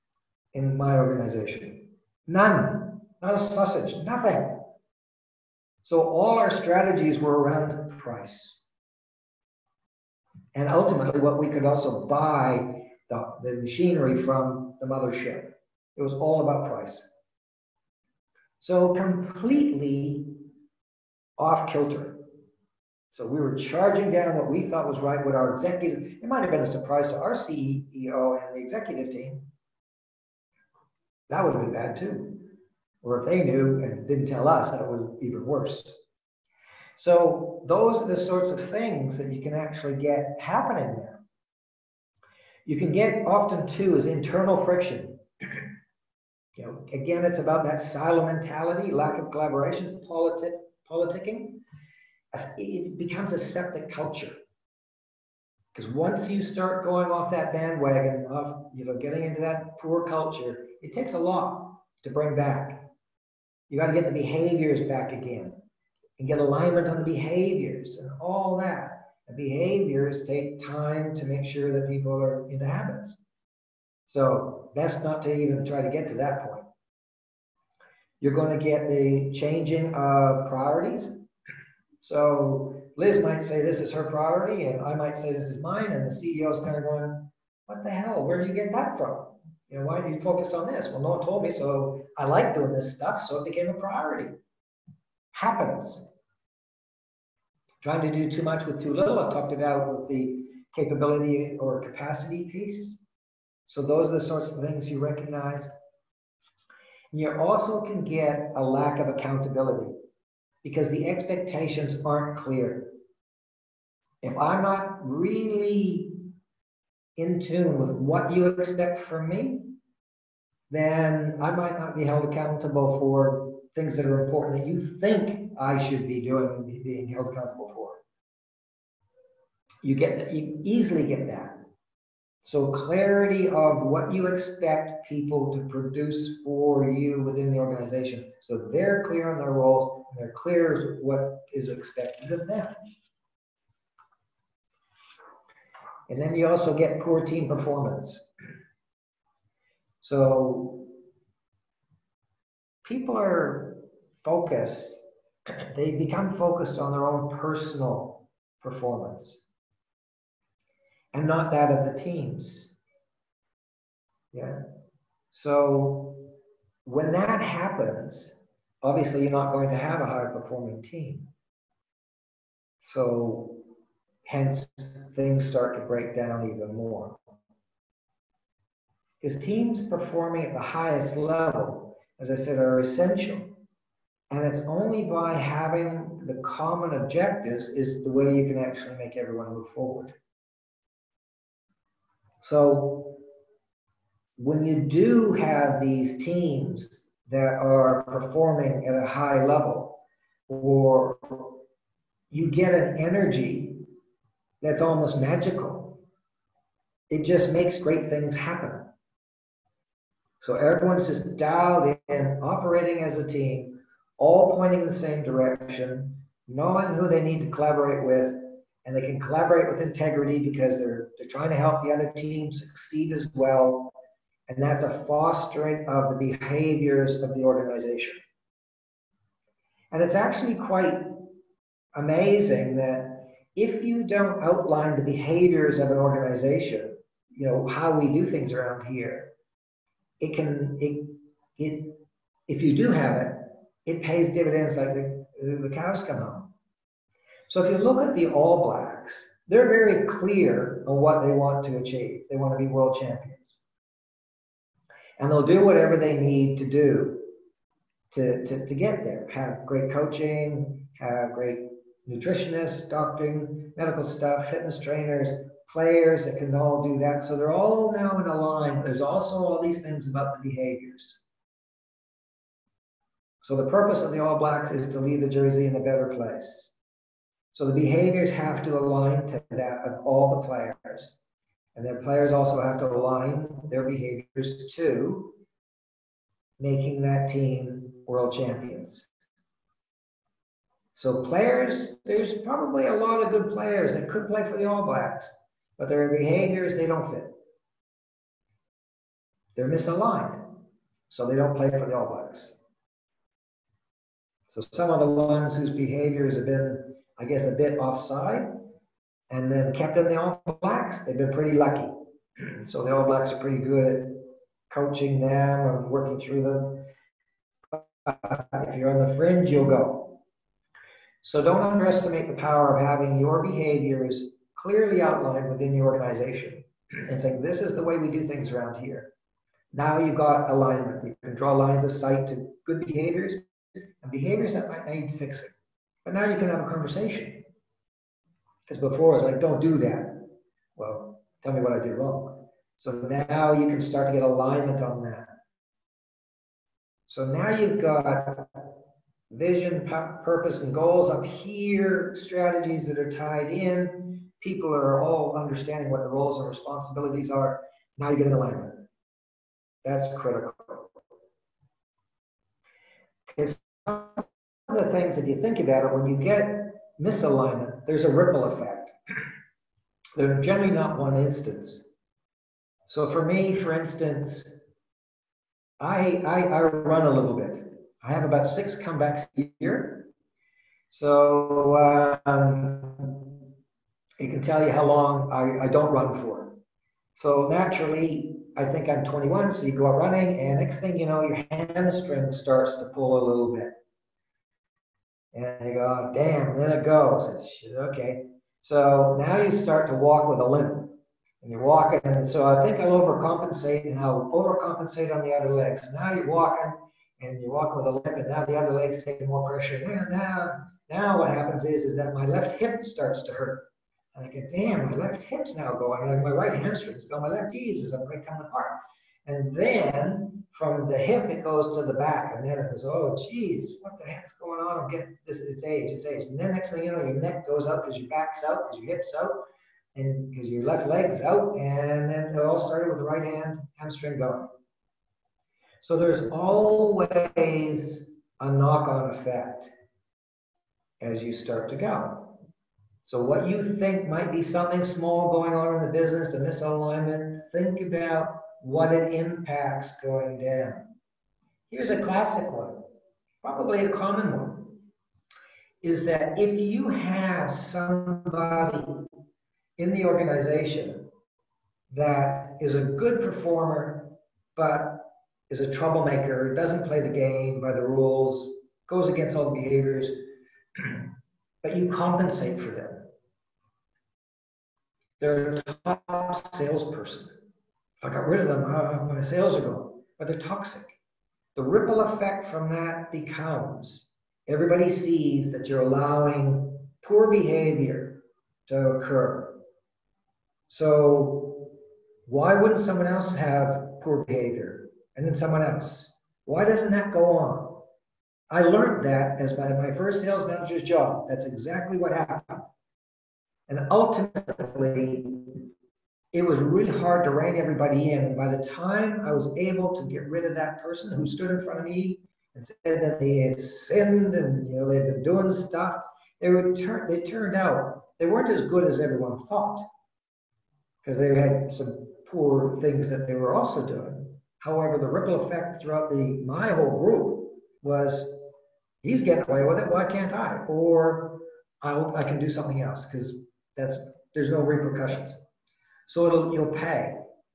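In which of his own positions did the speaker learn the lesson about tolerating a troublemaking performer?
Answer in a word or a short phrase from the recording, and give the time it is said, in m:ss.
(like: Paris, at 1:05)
first sales manager's job, at 8:19.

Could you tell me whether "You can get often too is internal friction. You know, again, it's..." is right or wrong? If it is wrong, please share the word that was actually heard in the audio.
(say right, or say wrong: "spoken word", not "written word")
right.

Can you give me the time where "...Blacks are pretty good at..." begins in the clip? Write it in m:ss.
5:13.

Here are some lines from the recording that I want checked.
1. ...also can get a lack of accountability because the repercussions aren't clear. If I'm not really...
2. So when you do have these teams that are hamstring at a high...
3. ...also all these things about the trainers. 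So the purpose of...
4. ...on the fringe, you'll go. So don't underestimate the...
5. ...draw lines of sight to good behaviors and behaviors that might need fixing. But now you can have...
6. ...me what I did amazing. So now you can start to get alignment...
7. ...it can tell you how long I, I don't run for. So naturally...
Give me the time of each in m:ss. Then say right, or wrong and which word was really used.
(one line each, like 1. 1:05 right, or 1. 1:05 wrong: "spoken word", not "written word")
1. 1:47 wrong: "expectations", not "repercussions"
2. 3:12 wrong: "performing", not "hamstring"
3. 4:29 wrong: "behaviors", not "trainers"
4. 5:18 right
5. 5:31 right
6. 5:41 wrong: "wrong", not "amazing"
7. 6:24 right.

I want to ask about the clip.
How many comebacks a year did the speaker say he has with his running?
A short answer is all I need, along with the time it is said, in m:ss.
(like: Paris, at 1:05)
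6, at 6:18.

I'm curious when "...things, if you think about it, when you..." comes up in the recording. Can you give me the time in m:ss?
6:04.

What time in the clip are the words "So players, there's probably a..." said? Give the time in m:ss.
4:50.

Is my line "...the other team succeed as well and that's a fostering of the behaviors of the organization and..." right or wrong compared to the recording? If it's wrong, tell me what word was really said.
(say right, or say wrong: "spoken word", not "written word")
right.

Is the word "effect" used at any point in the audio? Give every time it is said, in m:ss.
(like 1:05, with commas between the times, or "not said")
6:08, 7:19, 8:02, 8:45.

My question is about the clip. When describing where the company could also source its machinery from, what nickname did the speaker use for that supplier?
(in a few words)
the mothership.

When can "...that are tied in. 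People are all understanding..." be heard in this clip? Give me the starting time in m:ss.
5:52.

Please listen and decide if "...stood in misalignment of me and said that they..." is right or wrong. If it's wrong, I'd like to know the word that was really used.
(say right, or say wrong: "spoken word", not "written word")
wrong: "front", not "misalignment".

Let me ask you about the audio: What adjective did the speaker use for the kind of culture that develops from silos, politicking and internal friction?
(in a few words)
septic.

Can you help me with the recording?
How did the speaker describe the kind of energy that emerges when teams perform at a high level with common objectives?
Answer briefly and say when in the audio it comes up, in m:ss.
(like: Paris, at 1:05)
almost magical, at 3:24.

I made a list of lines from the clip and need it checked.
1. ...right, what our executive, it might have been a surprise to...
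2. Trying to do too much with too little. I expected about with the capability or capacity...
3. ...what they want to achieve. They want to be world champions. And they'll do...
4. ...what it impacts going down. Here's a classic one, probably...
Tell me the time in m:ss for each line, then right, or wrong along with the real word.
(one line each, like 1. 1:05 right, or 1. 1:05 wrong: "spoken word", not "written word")
1. 0:24 right
2. 1:37 wrong: "talked", not "expected"
3. 4:11 right
4. 7:28 right.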